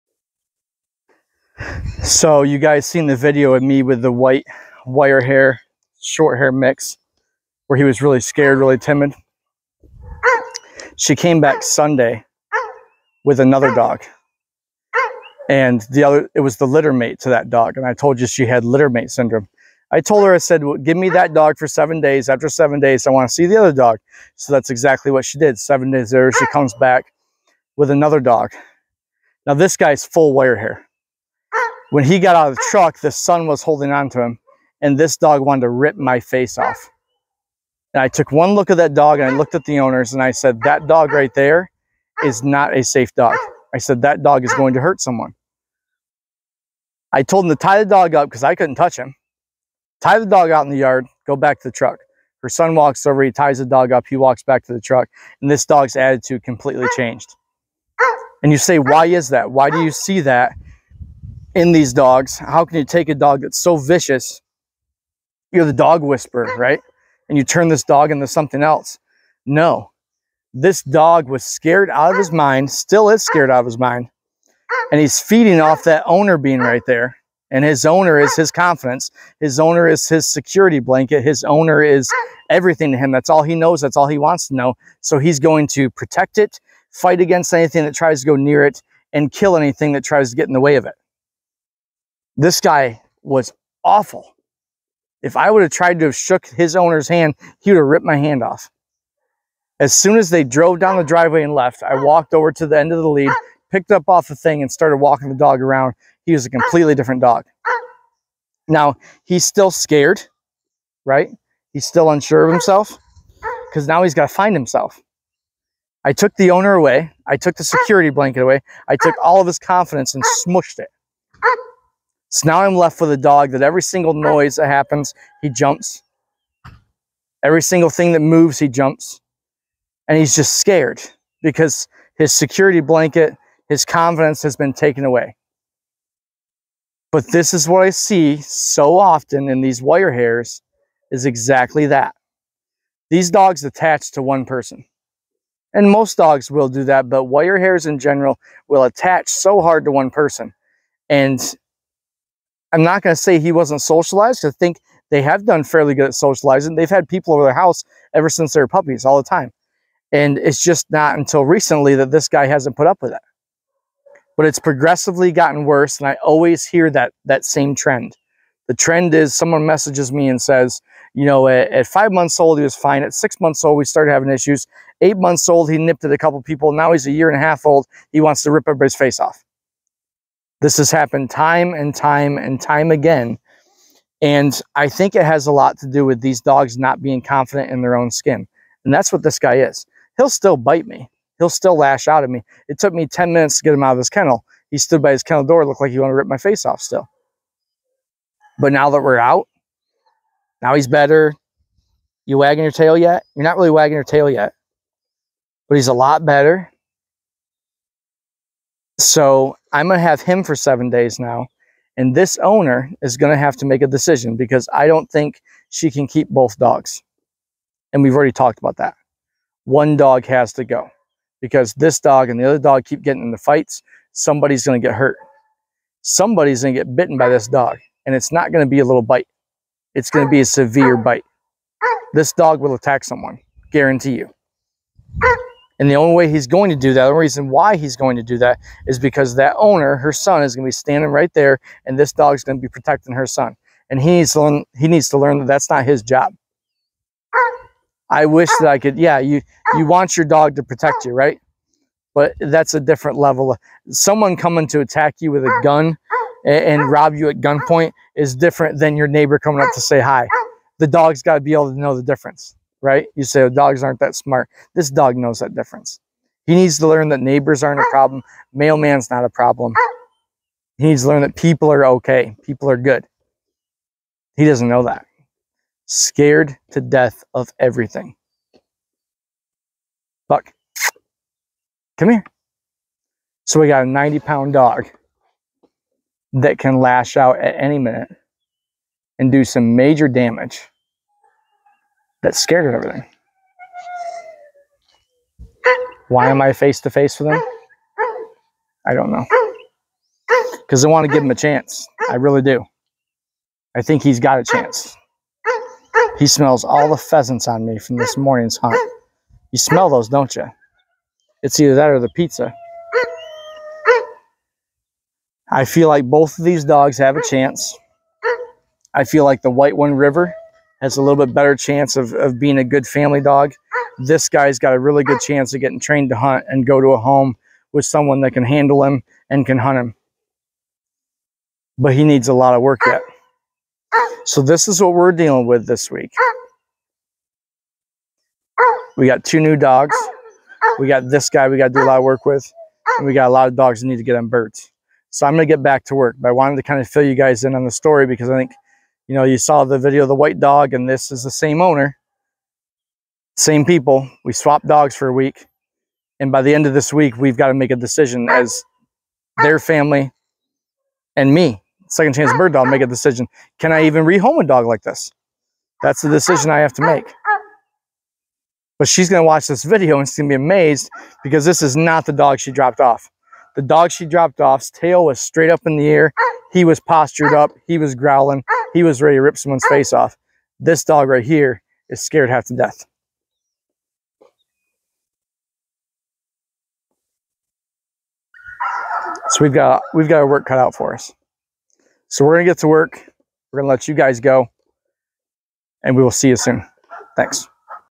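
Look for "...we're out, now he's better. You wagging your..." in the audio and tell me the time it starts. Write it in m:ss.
3:19.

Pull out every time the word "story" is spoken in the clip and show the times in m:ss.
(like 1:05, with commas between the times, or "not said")
5:47.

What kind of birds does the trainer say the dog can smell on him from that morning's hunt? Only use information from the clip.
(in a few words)
Pheasants.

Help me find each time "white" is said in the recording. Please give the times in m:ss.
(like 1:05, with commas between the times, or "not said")
0:04, 5:19, 5:50.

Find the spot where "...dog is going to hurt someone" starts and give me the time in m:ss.
0:44.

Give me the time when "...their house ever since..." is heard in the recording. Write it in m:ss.
2:37.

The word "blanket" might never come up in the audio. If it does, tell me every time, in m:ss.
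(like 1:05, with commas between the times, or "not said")
1:20, 1:58, 2:12.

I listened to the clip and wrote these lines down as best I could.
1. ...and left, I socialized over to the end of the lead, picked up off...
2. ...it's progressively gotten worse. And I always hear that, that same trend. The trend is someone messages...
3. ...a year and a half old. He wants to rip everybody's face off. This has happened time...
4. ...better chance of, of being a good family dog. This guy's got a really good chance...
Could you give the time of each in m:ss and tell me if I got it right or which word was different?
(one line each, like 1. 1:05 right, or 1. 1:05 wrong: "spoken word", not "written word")
1. 1:41 wrong: "walked", not "socialized"
2. 2:44 right
3. 2:57 right
4. 5:21 right.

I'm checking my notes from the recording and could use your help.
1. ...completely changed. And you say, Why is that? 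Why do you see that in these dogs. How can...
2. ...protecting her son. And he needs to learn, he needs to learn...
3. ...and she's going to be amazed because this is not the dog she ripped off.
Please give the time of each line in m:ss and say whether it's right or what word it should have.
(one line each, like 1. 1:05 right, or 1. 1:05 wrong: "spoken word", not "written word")
1. 0:56 right
2. 4:02 right
3. 6:09 wrong: "dropped", not "ripped".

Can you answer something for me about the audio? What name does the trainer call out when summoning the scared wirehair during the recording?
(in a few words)
Buck.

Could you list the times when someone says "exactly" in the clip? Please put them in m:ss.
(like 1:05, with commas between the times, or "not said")
0:24, 2:21.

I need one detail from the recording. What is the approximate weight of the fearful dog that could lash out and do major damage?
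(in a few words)
90 pounds.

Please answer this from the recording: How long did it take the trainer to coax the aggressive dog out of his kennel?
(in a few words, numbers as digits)
10 minutes.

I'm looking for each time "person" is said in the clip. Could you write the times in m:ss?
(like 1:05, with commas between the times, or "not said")
2:24, 2:30.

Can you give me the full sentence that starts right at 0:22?
After seven days, I want to see the other dog.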